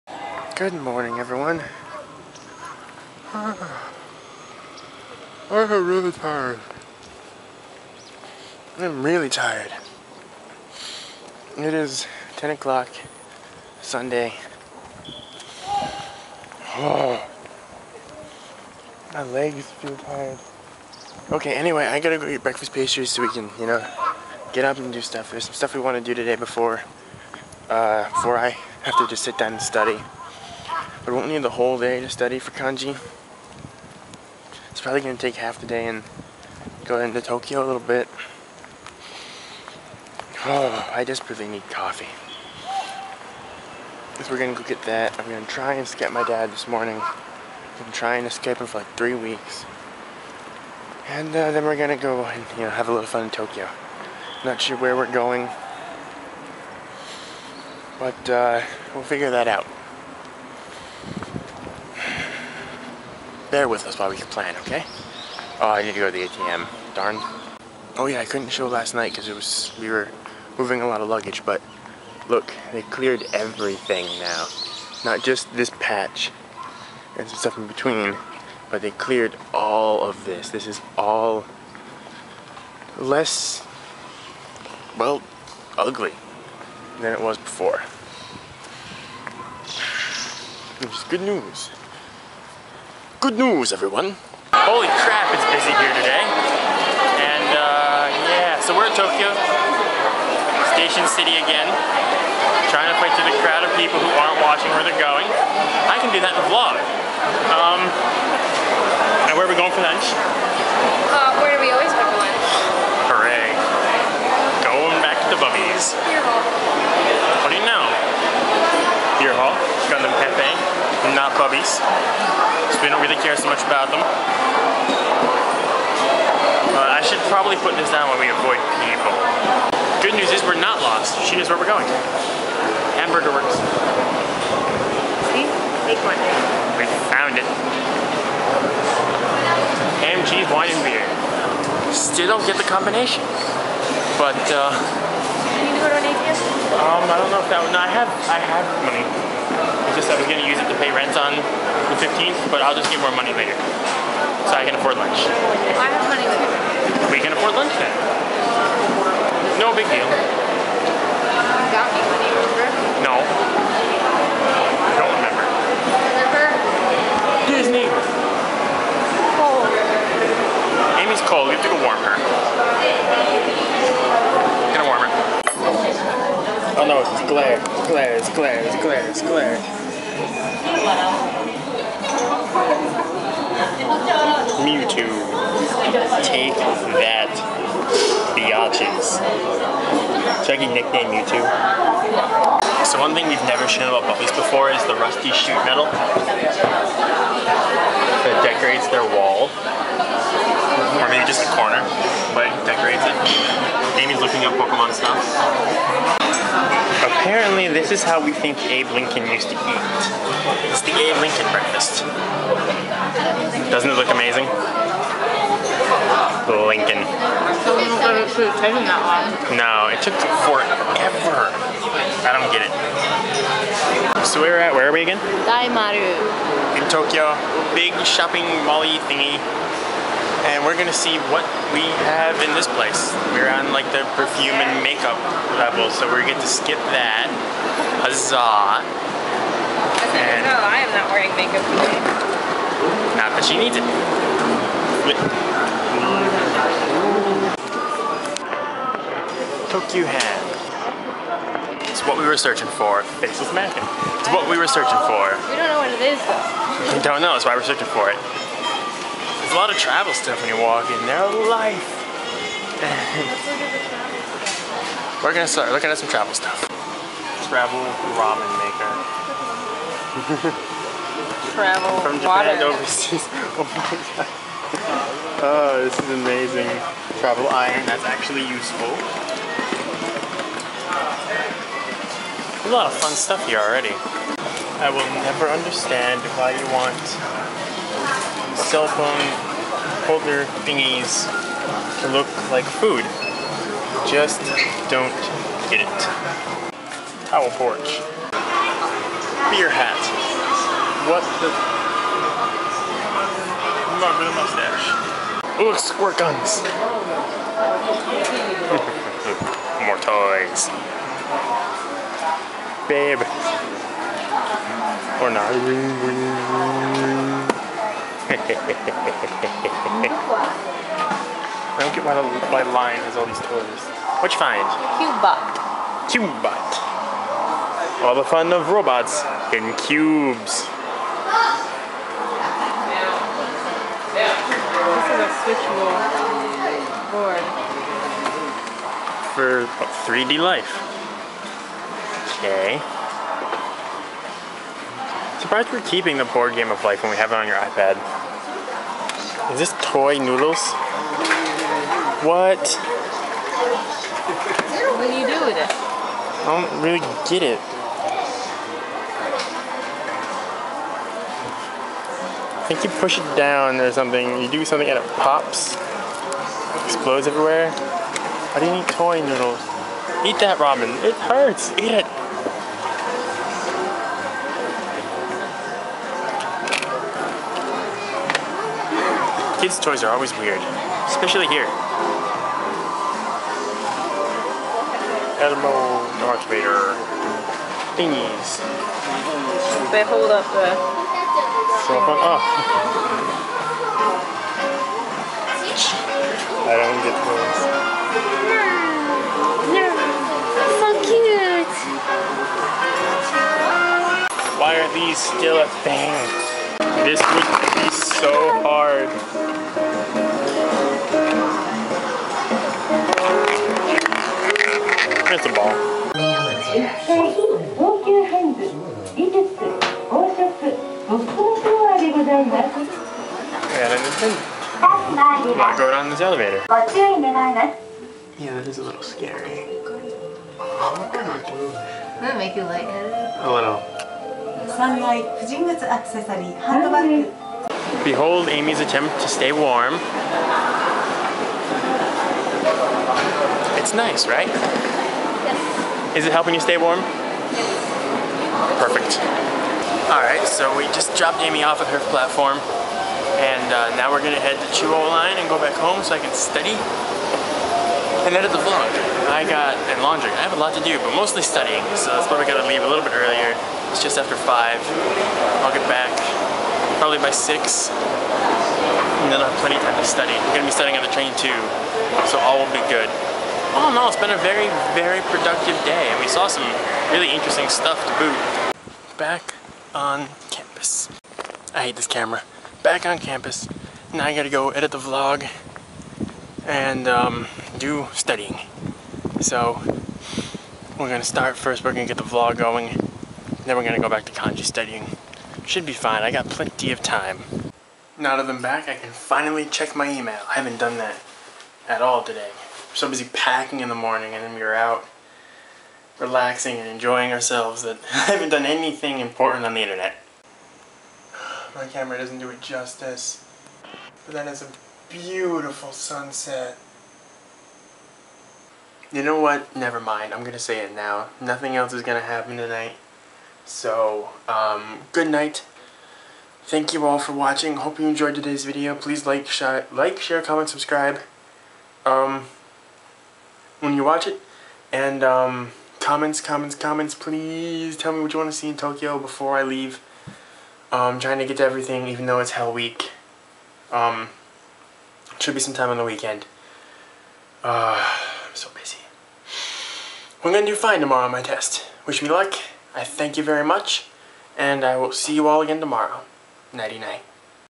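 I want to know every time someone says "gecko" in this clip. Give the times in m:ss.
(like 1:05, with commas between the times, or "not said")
not said.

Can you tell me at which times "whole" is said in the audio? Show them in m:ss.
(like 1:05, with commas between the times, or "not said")
0:31.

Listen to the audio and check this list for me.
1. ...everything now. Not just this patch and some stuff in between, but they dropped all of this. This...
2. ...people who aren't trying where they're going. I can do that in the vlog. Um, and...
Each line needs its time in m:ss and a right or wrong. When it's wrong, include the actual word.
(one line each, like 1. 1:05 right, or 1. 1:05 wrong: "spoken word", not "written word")
1. 1:13 wrong: "cleared", not "dropped"
2. 1:43 wrong: "watching", not "trying".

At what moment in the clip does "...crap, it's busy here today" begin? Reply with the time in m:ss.
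1:35.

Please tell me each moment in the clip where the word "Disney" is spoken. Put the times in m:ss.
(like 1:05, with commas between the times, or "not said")
2:47.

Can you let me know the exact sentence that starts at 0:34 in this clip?
It's probably going to take half the day and go into Tokyo a little bit.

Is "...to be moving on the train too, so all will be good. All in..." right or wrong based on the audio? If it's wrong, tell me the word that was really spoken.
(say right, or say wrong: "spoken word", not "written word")
wrong: "studying", not "moving".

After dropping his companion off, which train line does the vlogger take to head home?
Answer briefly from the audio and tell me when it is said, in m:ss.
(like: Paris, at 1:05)
Chuo Line, at 7:34.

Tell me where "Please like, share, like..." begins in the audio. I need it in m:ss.
8:48.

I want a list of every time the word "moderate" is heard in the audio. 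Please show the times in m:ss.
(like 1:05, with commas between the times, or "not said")
not said.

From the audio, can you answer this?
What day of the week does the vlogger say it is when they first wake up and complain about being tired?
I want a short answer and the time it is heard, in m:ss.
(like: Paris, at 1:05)
Sunday, at 0:13.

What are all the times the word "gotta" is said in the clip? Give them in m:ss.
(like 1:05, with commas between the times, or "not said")
0:21, 7:42, 8:04.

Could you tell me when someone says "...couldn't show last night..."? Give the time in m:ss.
1:08.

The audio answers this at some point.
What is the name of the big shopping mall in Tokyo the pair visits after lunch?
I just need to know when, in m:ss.
3:45.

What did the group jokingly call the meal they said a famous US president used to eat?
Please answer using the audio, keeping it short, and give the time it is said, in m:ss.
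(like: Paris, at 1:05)
Abe Lincoln breakfast, at 3:30.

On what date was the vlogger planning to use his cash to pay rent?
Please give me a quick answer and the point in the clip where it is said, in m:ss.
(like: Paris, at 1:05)
15th, at 2:32.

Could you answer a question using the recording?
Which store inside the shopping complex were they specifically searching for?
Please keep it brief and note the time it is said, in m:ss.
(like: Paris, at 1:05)
Tokyu Hands, at 4:09.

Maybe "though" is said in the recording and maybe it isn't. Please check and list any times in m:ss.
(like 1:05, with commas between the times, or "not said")
4:16, 9:02.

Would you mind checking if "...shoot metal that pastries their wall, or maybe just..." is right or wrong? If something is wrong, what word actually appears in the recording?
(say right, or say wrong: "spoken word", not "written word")
wrong: "decorates", not "pastries".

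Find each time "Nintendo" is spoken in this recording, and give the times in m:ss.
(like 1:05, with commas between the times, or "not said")
7:03.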